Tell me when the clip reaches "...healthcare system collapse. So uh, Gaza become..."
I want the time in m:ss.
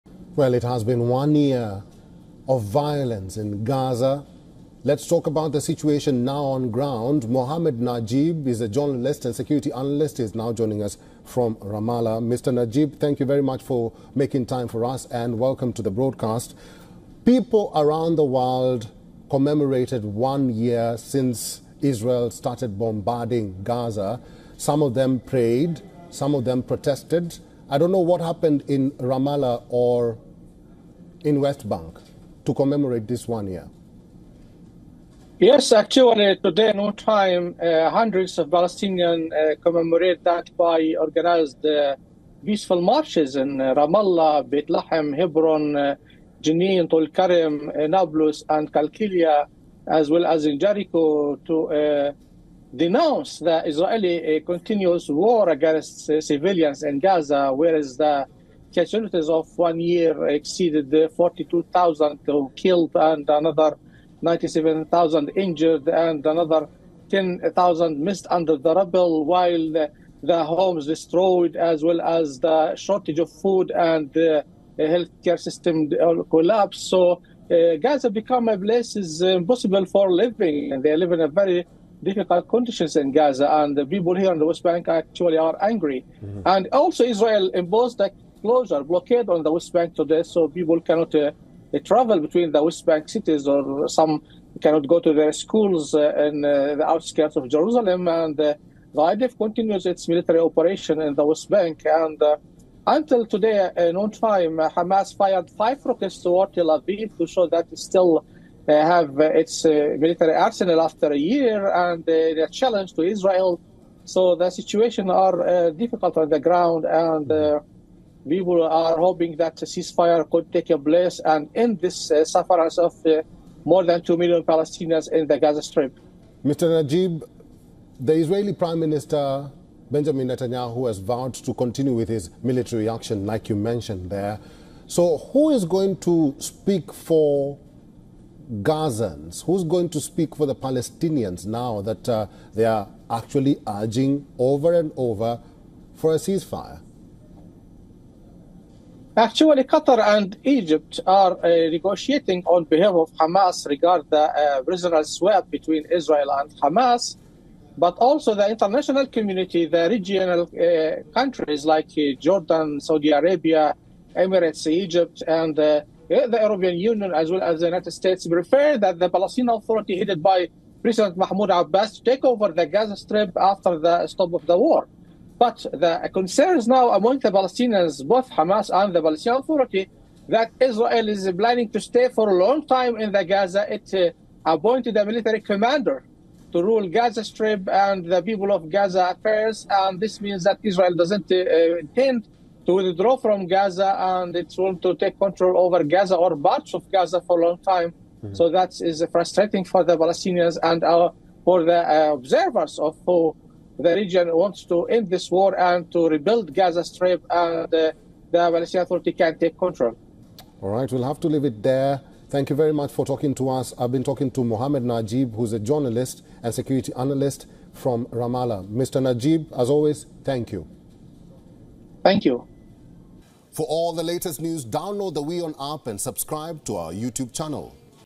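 1:14.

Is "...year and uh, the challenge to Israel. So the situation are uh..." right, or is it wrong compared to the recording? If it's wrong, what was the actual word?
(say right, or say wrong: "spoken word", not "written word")
right.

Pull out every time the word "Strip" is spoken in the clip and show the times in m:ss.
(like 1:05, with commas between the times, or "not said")
2:05, 2:52, 3:07, 3:26.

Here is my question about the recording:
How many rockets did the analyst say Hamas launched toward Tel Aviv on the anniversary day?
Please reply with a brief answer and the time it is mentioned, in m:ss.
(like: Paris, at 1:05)
5, at 1:45.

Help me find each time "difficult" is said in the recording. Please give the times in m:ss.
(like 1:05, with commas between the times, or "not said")
1:22, 1:55.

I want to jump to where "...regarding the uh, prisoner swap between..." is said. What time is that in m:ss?
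2:33.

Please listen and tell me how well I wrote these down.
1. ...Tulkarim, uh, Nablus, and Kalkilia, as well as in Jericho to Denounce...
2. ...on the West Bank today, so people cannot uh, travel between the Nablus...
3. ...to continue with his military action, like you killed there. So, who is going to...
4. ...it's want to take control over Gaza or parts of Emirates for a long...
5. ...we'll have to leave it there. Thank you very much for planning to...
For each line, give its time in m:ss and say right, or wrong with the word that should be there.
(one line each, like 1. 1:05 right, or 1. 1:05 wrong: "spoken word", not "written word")
1. 0:46 right
2. 1:29 wrong: "West", not "Nablus"
3. 2:11 wrong: "mentioned", not "killed"
4. 3:14 wrong: "Gaza", not "Emirates"
5. 3:30 wrong: "talking", not "planning".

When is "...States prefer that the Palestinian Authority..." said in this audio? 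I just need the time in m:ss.
2:47.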